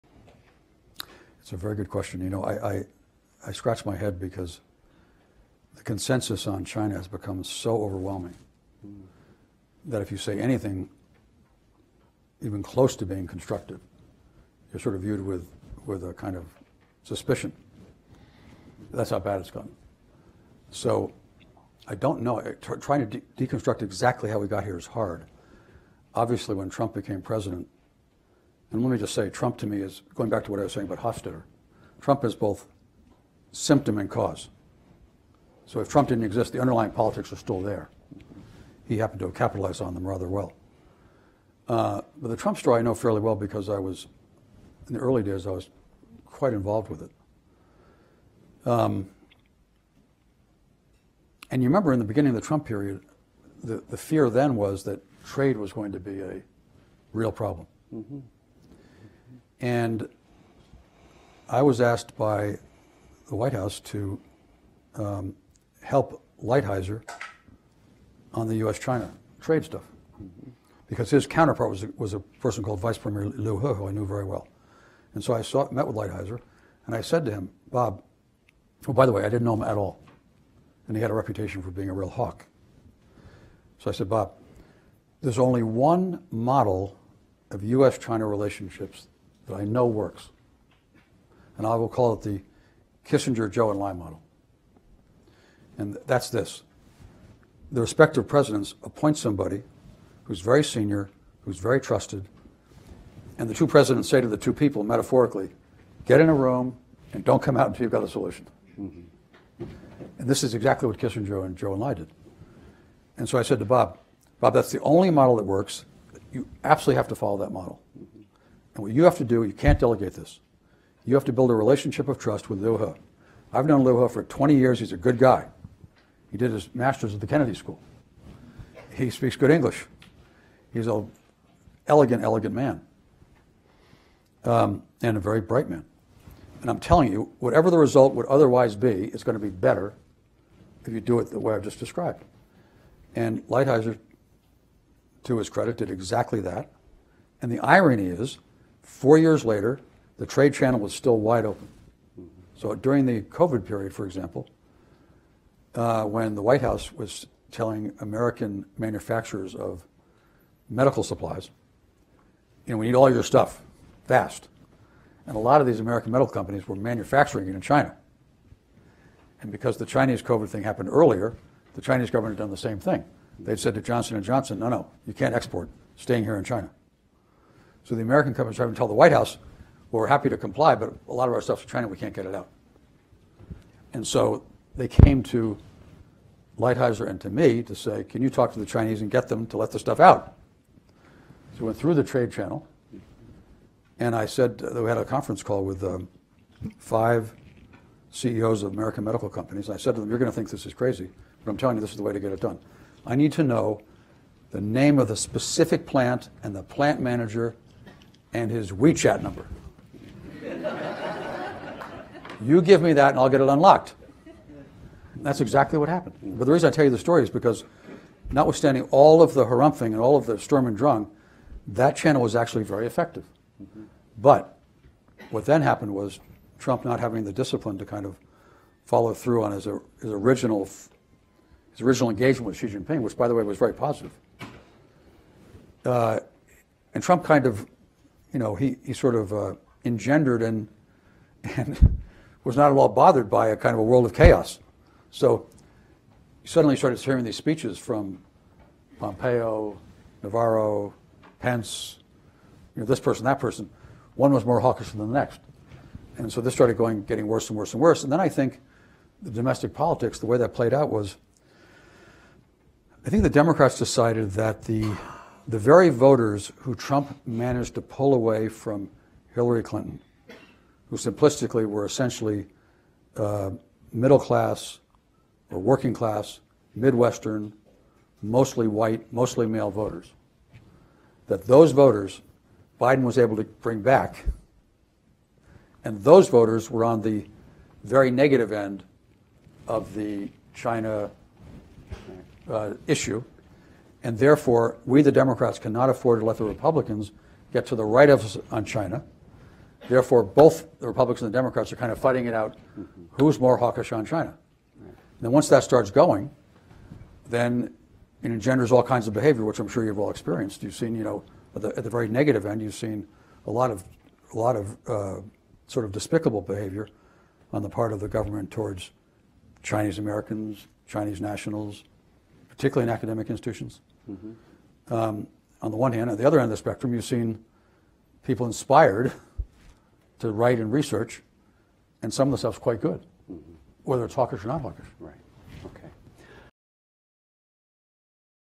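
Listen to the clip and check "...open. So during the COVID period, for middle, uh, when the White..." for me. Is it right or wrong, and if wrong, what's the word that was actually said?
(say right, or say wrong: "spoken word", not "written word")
wrong: "example", not "middle".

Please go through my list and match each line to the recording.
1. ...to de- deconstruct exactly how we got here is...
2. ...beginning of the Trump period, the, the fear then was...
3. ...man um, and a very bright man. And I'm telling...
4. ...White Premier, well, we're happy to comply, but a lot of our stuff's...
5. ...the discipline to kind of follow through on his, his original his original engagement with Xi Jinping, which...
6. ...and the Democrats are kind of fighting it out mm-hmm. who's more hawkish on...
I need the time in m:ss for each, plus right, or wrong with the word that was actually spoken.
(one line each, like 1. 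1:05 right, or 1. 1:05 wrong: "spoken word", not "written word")
1. 0:23 right
2. 0:52 right
3. 2:12 right
4. 2:58 wrong: "House", not "Premier"
5. 3:47 right
6. 5:01 right.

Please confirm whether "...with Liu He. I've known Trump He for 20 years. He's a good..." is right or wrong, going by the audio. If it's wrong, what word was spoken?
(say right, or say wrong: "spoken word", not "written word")
wrong: "Liu", not "Trump".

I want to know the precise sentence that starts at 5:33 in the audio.
whether it's hawkish or not hawkish.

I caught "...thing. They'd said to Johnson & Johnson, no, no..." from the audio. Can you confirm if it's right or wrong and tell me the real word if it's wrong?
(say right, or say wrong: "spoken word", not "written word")
right.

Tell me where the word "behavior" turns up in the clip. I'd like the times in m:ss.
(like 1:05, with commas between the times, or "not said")
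5:09, 5:16.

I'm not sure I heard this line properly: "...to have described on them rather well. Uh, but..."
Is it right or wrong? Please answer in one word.
wrong.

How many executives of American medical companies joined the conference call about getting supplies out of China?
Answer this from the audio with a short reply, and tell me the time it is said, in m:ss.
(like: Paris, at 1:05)
5, at 3:16.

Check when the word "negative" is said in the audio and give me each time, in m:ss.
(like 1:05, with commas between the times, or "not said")
4:48, 5:12.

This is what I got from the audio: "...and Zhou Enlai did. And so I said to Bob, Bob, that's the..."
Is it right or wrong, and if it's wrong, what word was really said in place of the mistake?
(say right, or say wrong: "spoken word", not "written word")
right.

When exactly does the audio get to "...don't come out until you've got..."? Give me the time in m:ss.
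1:47.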